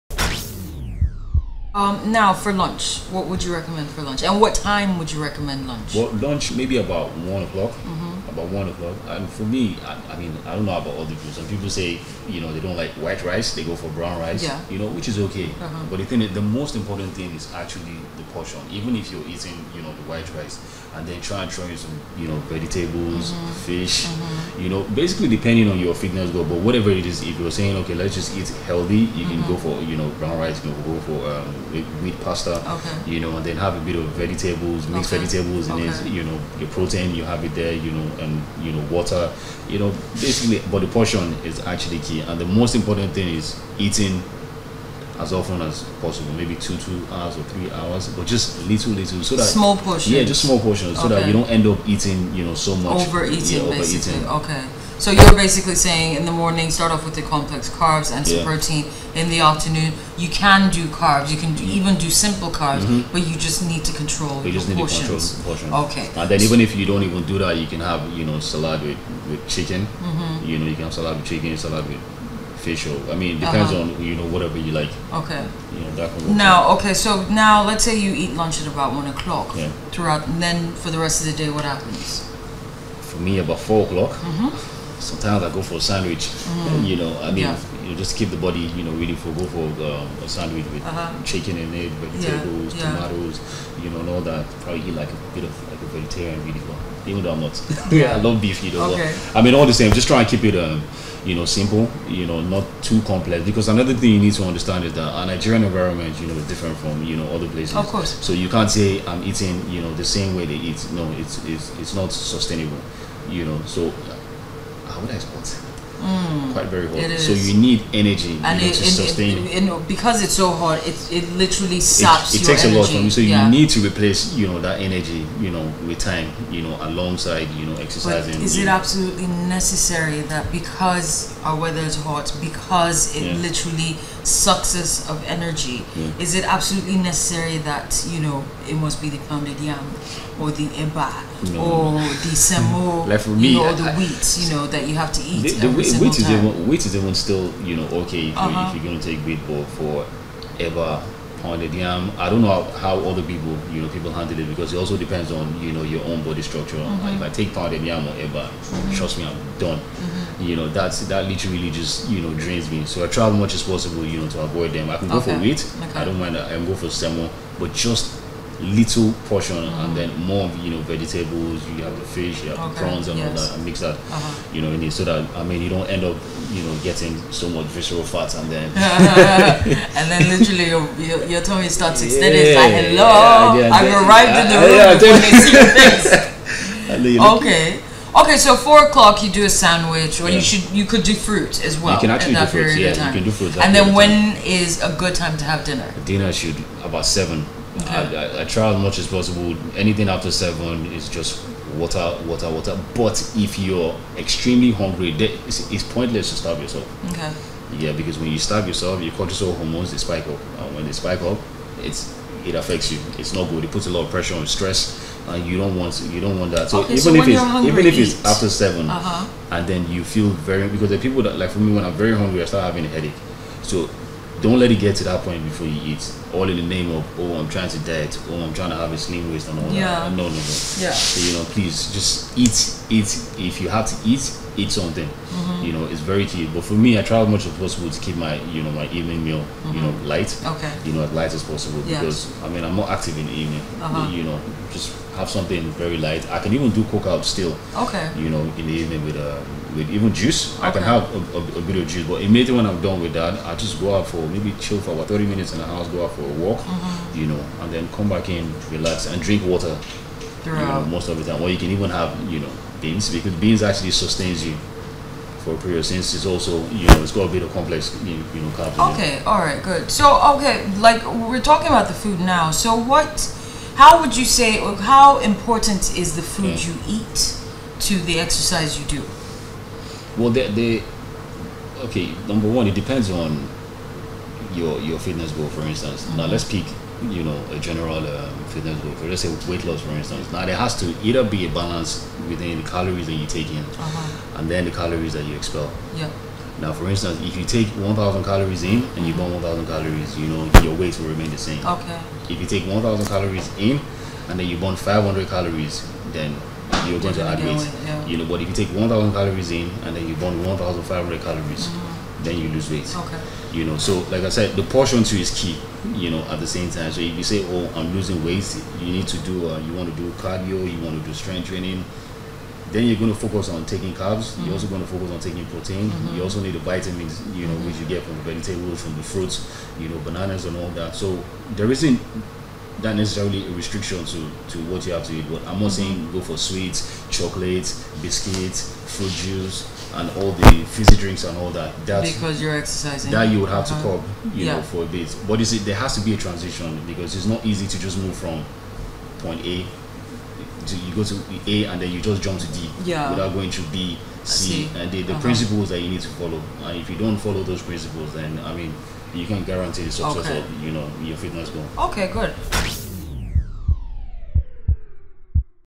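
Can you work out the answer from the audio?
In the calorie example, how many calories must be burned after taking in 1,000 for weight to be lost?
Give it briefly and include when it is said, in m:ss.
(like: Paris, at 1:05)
1,500, at 5:10.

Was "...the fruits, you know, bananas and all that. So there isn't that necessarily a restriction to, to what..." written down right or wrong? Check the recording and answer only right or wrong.
right.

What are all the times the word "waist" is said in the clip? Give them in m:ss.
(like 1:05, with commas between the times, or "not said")
3:49.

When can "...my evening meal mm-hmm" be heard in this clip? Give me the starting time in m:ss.
3:58.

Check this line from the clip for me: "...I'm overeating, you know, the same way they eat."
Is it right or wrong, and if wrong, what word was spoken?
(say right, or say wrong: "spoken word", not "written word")
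wrong: "eating", not "overeating".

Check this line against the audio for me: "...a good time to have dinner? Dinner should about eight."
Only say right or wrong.
wrong.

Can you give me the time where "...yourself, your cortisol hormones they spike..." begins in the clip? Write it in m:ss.
3:28.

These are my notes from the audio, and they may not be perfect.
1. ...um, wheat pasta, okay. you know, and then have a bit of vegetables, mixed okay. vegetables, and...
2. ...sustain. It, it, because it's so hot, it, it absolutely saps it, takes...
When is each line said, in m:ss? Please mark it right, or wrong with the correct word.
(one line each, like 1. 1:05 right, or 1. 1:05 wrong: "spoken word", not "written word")
1. 0:31 right
2. 1:58 wrong: "literally", not "absolutely".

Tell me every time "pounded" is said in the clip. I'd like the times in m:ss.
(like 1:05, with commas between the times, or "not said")
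2:19, 2:31, 2:37.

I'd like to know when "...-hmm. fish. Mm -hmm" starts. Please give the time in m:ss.
0:23.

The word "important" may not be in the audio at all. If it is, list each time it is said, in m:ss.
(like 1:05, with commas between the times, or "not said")
0:16, 0:42, 4:35.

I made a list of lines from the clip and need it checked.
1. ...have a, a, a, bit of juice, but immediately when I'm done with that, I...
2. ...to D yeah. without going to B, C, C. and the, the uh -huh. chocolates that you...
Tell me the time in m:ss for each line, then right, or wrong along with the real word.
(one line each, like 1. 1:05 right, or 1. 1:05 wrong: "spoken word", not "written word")
1. 4:10 right
2. 5:52 wrong: "principles", not "chocolates".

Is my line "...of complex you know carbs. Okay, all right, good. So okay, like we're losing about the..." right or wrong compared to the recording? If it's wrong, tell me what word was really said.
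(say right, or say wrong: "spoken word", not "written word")
wrong: "talking", not "losing".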